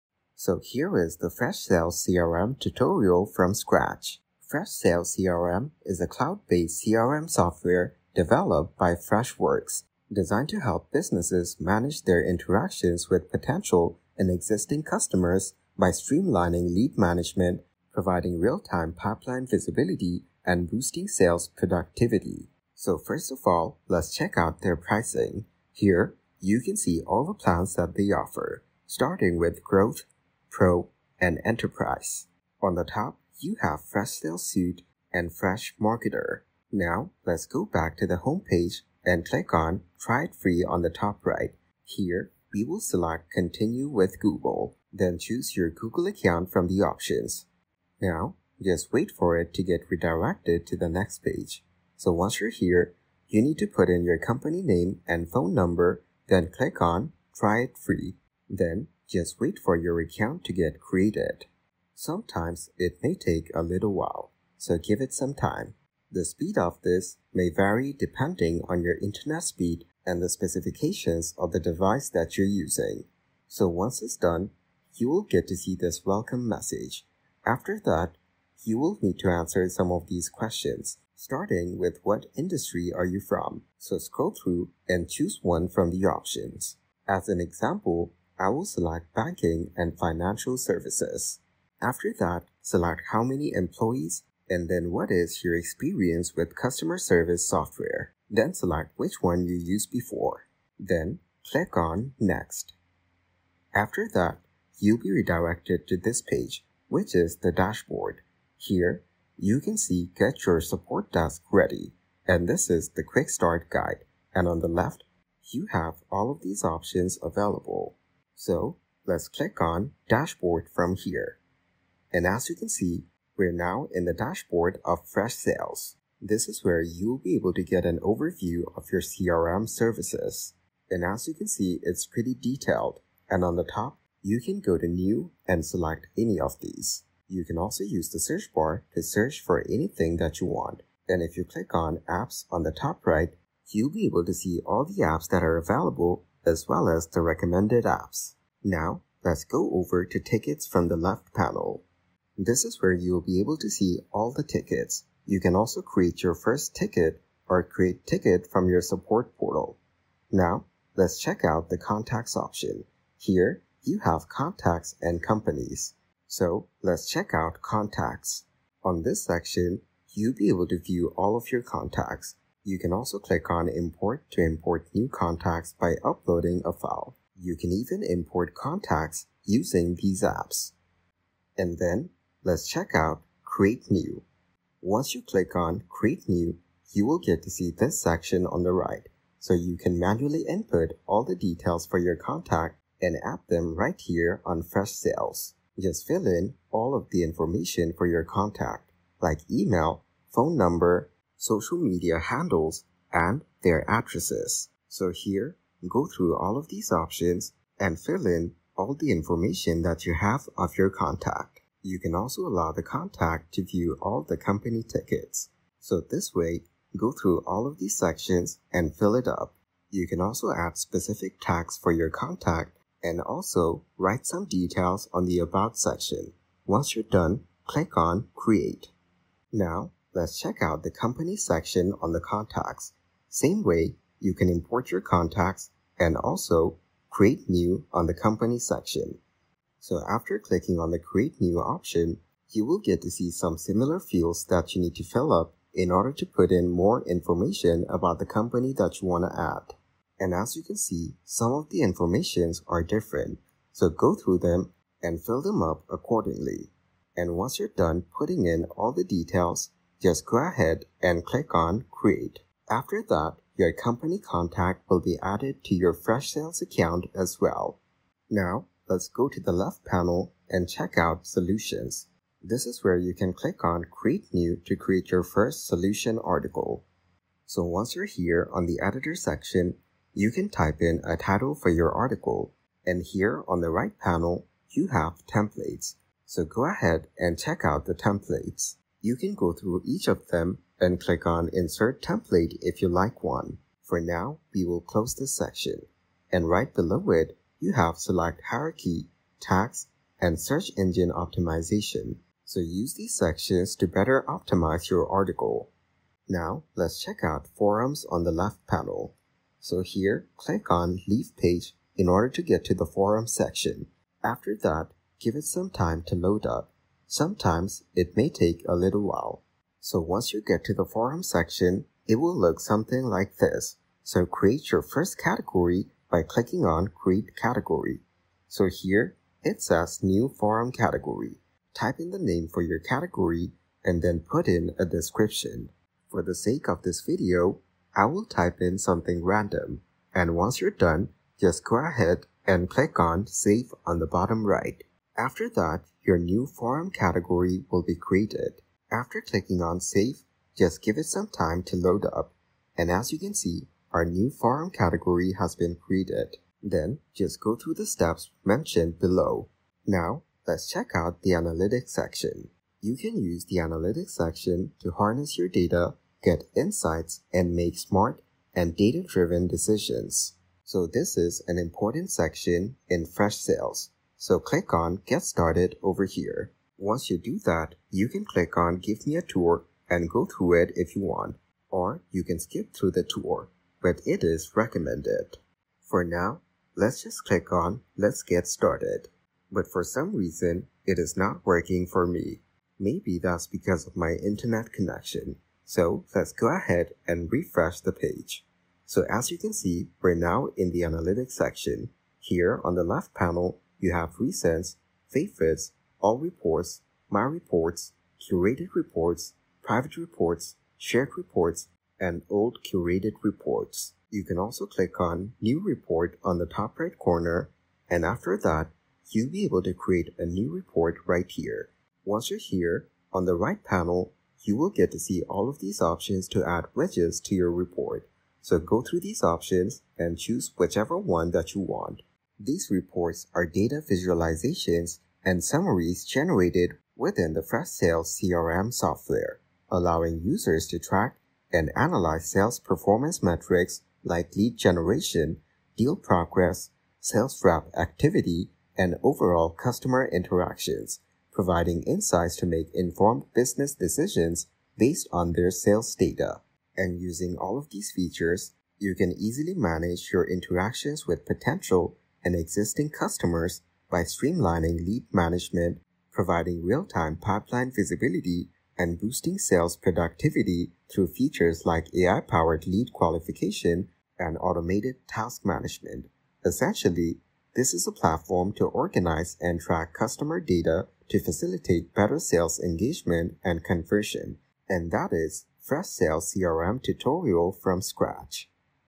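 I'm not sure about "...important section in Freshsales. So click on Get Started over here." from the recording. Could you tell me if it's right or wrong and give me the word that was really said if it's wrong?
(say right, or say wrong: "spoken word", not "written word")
right.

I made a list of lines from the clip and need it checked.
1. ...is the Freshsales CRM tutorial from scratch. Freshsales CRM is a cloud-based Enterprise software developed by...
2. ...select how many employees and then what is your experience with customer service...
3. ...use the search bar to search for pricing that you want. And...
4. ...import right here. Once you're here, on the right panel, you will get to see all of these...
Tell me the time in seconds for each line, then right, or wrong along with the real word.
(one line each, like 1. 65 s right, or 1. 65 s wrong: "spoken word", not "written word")
1. 0 s wrong: "CRM", not "Enterprise"
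2. 92 s right
3. 137 s wrong: "anything", not "pricing"
4. 420 s wrong: "report", not "import".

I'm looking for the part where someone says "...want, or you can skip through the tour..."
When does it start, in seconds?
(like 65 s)
381 s.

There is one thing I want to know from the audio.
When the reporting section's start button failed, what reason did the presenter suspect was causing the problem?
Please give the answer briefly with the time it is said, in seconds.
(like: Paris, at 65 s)
Internet connection, at 394 s.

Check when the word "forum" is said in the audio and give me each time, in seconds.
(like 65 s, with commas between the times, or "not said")
307 s, 312 s, 320 s, 330 s, 346 s, 354 s.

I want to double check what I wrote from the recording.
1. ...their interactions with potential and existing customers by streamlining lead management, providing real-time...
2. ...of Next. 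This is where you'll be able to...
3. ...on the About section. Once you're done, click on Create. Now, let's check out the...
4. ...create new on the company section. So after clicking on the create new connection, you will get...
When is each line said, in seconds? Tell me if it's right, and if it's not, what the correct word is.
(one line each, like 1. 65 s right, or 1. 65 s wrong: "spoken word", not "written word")
1. 12 s right
2. 124 s wrong: "Freshsales", not "Next"
3. 225 s right
4. 237 s wrong: "option", not "connection".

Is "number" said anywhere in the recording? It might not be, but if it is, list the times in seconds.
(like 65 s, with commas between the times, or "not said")
55 s, 200 s.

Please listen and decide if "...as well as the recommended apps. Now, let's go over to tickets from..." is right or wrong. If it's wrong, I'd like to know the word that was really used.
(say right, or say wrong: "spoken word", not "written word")
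right.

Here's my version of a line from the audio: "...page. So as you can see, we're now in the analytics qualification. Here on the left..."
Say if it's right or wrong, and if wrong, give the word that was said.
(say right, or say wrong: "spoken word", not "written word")
wrong: "section", not "qualification".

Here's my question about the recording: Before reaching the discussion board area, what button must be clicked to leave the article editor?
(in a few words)
Leave Page.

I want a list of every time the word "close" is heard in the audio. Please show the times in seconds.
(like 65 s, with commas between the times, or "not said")
294 s.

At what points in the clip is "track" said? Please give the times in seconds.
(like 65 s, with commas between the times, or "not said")
440 s, 479 s.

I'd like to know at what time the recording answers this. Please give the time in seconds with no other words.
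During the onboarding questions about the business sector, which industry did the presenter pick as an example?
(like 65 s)
89 s.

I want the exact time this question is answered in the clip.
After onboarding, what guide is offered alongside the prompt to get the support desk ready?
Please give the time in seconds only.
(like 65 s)
113 s.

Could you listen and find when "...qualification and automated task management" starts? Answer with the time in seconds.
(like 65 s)
472 s.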